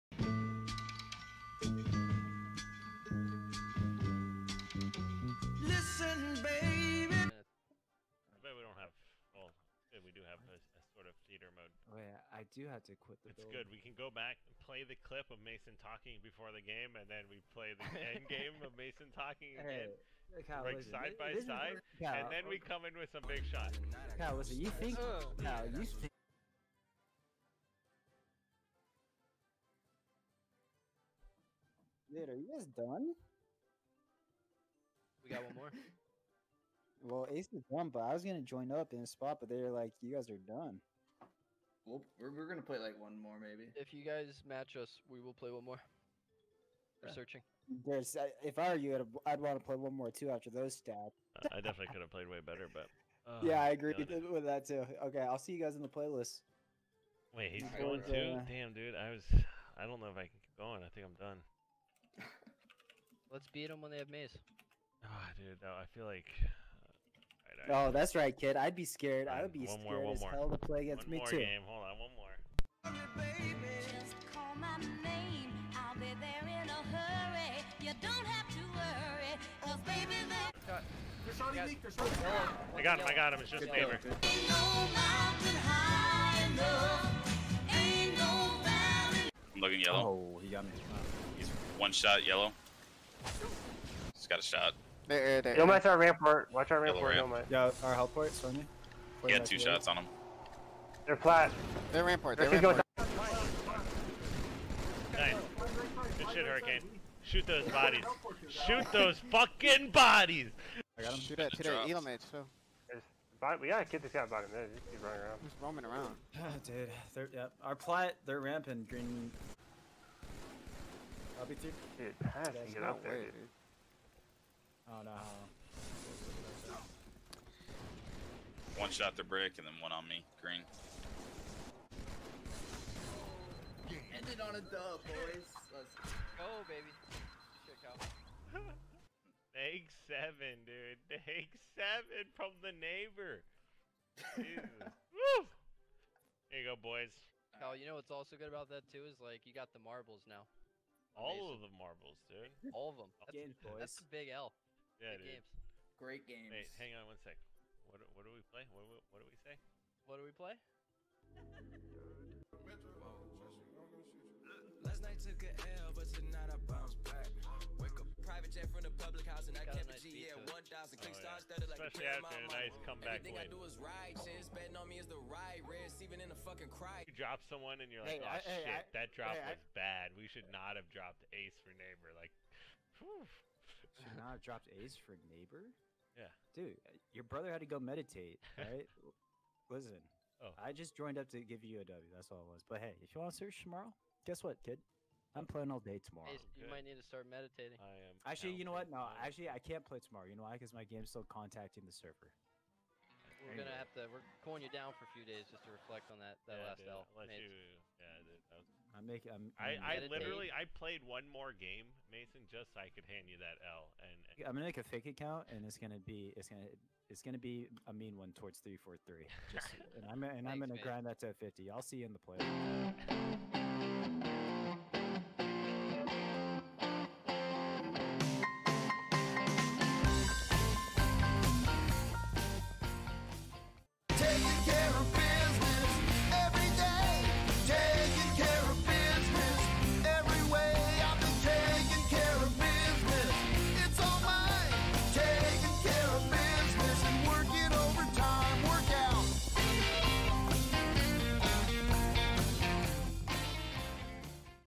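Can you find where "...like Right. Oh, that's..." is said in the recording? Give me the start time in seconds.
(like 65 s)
66 s.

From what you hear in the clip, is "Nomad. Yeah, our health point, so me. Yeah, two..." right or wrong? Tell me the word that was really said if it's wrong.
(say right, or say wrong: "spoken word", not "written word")
right.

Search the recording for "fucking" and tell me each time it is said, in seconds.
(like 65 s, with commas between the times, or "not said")
109 s, 176 s.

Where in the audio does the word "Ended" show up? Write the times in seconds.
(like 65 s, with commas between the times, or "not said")
134 s.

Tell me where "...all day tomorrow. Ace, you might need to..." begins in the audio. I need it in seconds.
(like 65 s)
195 s.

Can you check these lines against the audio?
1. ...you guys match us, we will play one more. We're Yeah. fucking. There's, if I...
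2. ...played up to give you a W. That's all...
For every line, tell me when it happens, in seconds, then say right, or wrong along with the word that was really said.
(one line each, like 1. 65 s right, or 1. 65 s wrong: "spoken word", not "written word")
1. 43 s wrong: "searching", not "fucking"
2. 190 s wrong: "joined", not "played".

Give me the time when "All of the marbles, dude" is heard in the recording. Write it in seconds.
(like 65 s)
151 s.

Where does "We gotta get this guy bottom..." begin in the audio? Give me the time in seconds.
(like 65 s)
113 s.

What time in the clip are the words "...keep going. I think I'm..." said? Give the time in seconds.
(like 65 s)
60 s.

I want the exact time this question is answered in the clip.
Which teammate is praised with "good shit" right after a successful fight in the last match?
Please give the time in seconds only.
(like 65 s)
106 s.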